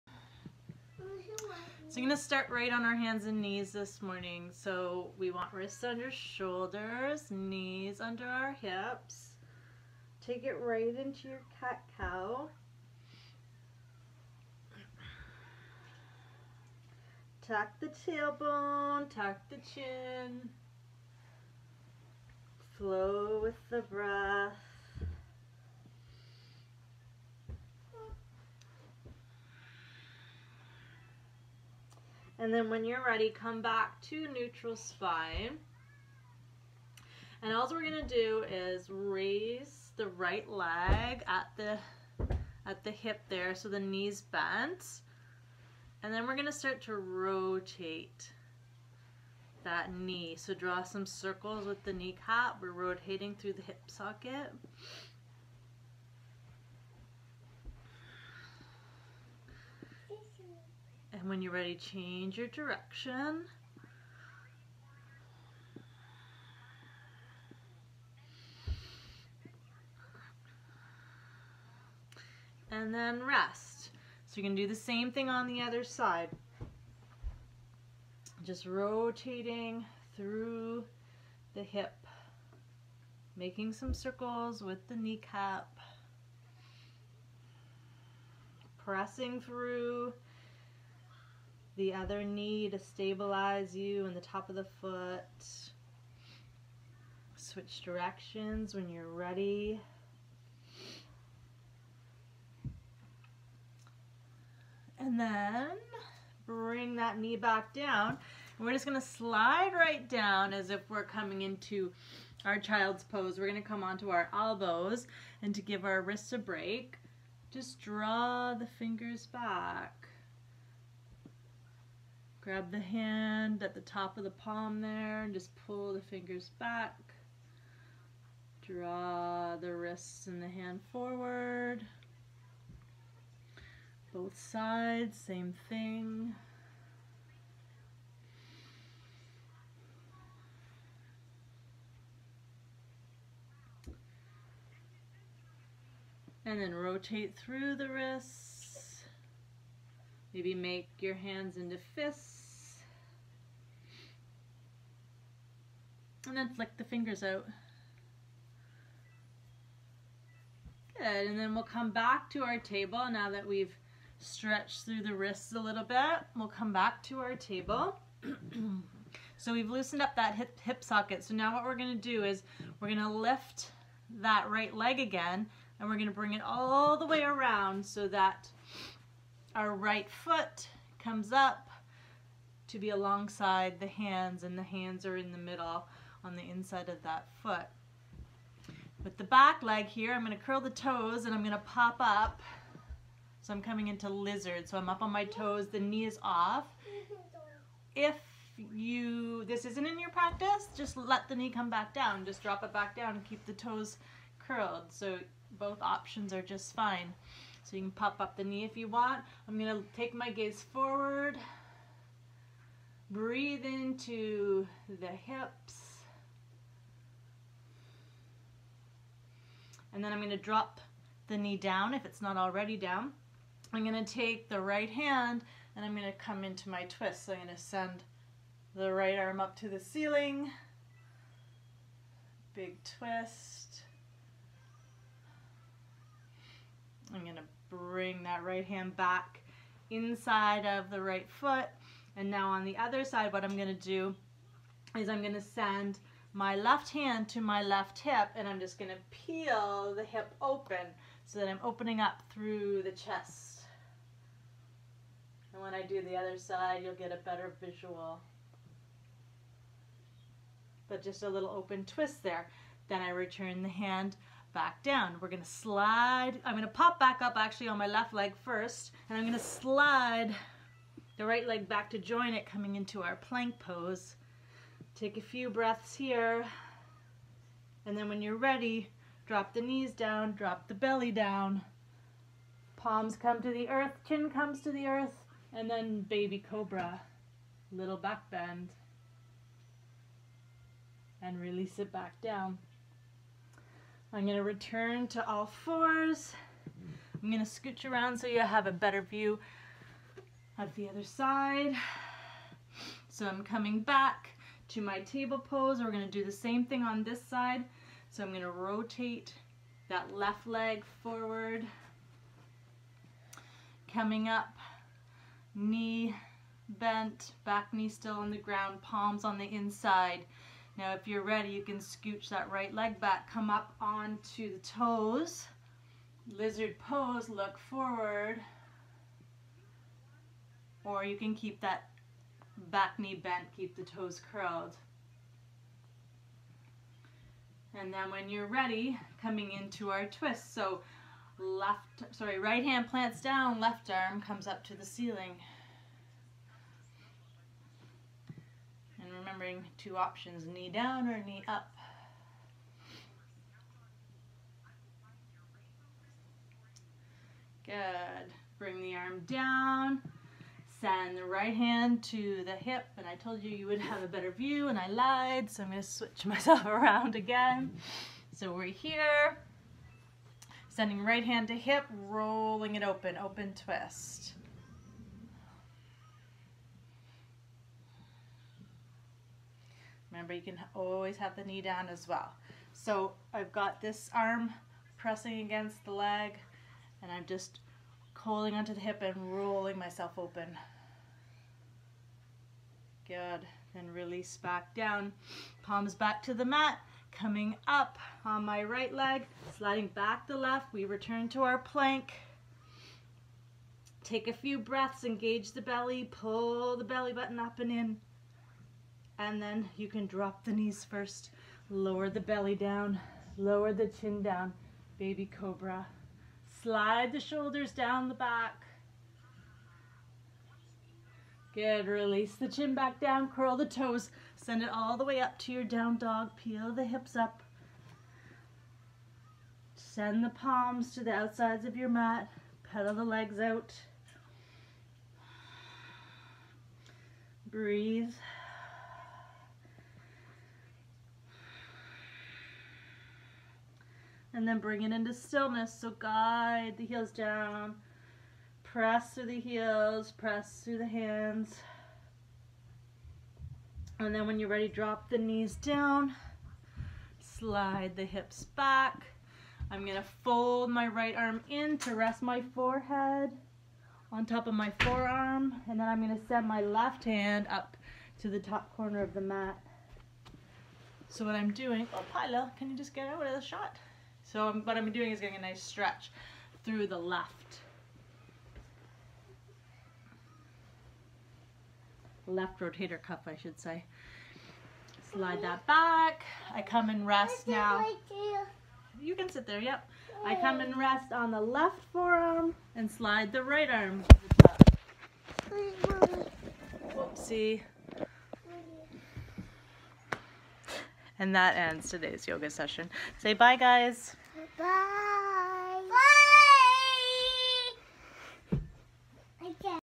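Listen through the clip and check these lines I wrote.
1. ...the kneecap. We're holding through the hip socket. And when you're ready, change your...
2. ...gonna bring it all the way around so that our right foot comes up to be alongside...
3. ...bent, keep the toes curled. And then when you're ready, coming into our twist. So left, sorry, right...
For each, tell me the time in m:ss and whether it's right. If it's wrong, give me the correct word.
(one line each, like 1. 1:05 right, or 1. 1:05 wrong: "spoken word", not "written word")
1. 0:51 wrong: "rotating", not "holding"
2. 2:55 right
3. 5:33 right.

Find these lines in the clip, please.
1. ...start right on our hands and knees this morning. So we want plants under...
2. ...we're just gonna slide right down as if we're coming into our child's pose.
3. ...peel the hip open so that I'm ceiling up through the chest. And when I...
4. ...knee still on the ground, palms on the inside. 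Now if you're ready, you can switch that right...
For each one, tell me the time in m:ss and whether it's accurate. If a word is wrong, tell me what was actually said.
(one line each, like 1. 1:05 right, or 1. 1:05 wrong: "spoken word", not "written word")
1. 0:02 wrong: "wrists", not "plants"
2. 1:48 right
3. 4:09 wrong: "opening", not "ceiling"
4. 5:17 wrong: "scooch", not "switch".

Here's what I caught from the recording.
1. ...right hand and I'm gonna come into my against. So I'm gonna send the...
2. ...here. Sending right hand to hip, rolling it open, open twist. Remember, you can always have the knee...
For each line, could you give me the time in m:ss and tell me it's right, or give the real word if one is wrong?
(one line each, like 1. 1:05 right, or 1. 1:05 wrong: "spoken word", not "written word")
1. 3:44 wrong: "twist", not "against"
2. 6:08 right.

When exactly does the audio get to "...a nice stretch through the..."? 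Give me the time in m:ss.
7:55.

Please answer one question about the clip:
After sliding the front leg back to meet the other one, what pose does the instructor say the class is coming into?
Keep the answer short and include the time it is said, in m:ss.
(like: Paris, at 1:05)
plank pose, at 4:33.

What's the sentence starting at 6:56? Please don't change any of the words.
Slide the shoulders down the back.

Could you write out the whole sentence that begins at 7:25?
So guide the heels down, press through the heels, press through the hands.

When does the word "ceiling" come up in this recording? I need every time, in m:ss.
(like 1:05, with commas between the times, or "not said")
3:49, 5:44.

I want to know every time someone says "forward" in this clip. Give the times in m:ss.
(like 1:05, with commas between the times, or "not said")
2:10, 3:30, 5:11, 5:27.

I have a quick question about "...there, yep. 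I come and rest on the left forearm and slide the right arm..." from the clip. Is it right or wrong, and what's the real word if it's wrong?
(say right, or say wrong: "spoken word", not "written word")
right.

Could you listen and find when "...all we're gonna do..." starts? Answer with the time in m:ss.
0:37.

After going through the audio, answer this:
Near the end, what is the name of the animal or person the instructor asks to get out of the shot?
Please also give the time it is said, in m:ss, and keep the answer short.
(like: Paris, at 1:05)
Pila, at 7:52.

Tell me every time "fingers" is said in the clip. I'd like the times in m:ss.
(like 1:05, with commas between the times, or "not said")
1:58, 2:06, 2:36.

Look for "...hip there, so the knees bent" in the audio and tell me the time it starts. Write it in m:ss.
0:42.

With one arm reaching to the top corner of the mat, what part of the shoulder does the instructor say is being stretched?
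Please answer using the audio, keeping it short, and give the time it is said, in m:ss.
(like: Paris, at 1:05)
left rotator cuff, at 8:02.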